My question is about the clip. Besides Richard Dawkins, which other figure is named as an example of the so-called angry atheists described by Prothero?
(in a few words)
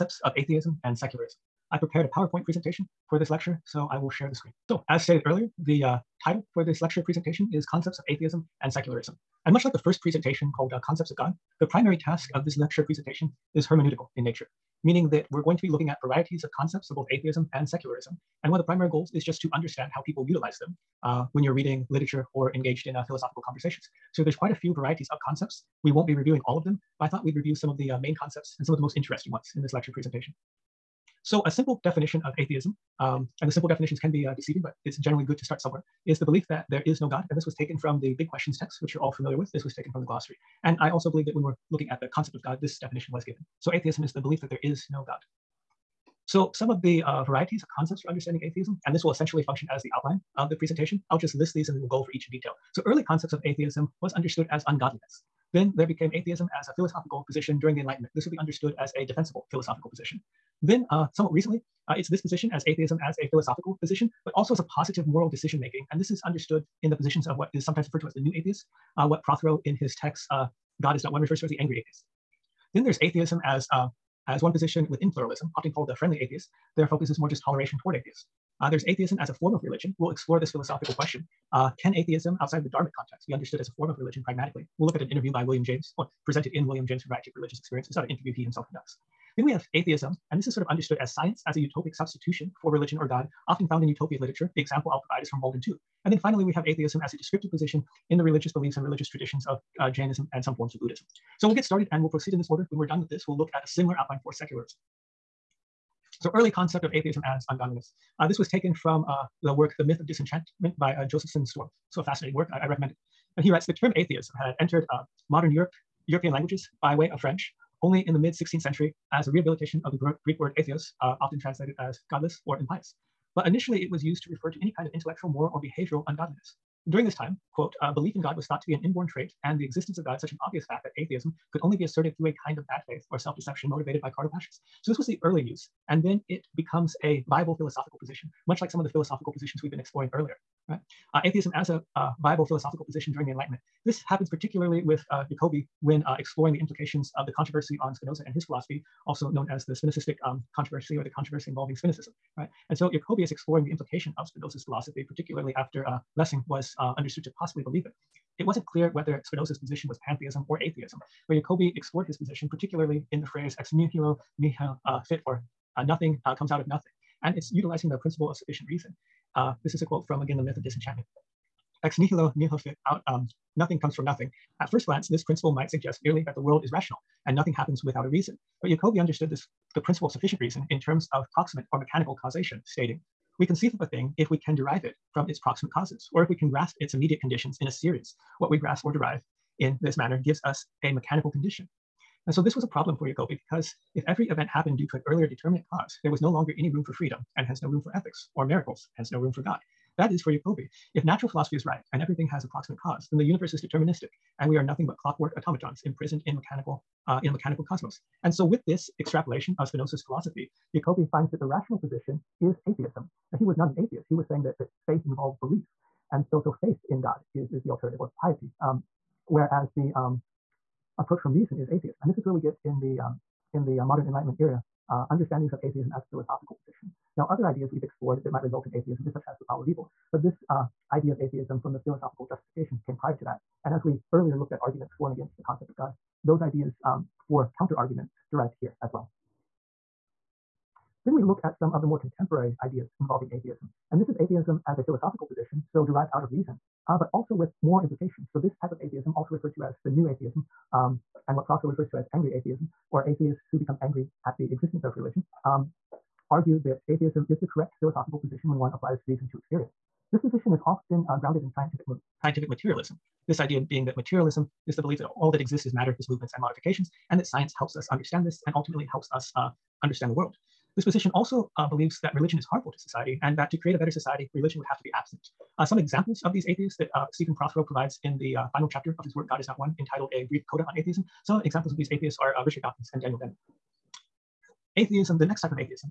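Daniel Dennett.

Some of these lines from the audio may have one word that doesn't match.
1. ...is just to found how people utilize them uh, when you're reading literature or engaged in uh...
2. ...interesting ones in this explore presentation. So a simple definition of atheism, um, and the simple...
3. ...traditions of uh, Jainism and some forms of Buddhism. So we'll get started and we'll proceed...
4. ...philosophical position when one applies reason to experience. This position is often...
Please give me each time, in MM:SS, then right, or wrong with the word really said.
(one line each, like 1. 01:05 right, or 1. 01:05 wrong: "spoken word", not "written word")
1. 00:19 wrong: "understand", not "found"
2. 00:28 wrong: "lecture", not "explore"
3. 01:39 right
4. 04:17 right.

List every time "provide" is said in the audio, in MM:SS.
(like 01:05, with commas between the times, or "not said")
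01:35, 04:37.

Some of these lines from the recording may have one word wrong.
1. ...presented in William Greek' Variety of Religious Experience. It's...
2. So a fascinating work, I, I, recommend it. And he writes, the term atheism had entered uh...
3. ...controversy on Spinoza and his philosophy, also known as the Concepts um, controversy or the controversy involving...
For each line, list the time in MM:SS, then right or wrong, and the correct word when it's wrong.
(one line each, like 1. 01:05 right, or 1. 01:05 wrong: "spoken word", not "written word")
1. 01:26 wrong: "James", not "Greek"
2. 01:51 right
3. 02:27 wrong: "Spinozistic", not "Concepts".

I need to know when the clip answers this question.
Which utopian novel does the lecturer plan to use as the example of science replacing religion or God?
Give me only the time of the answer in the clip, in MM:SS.
01:35.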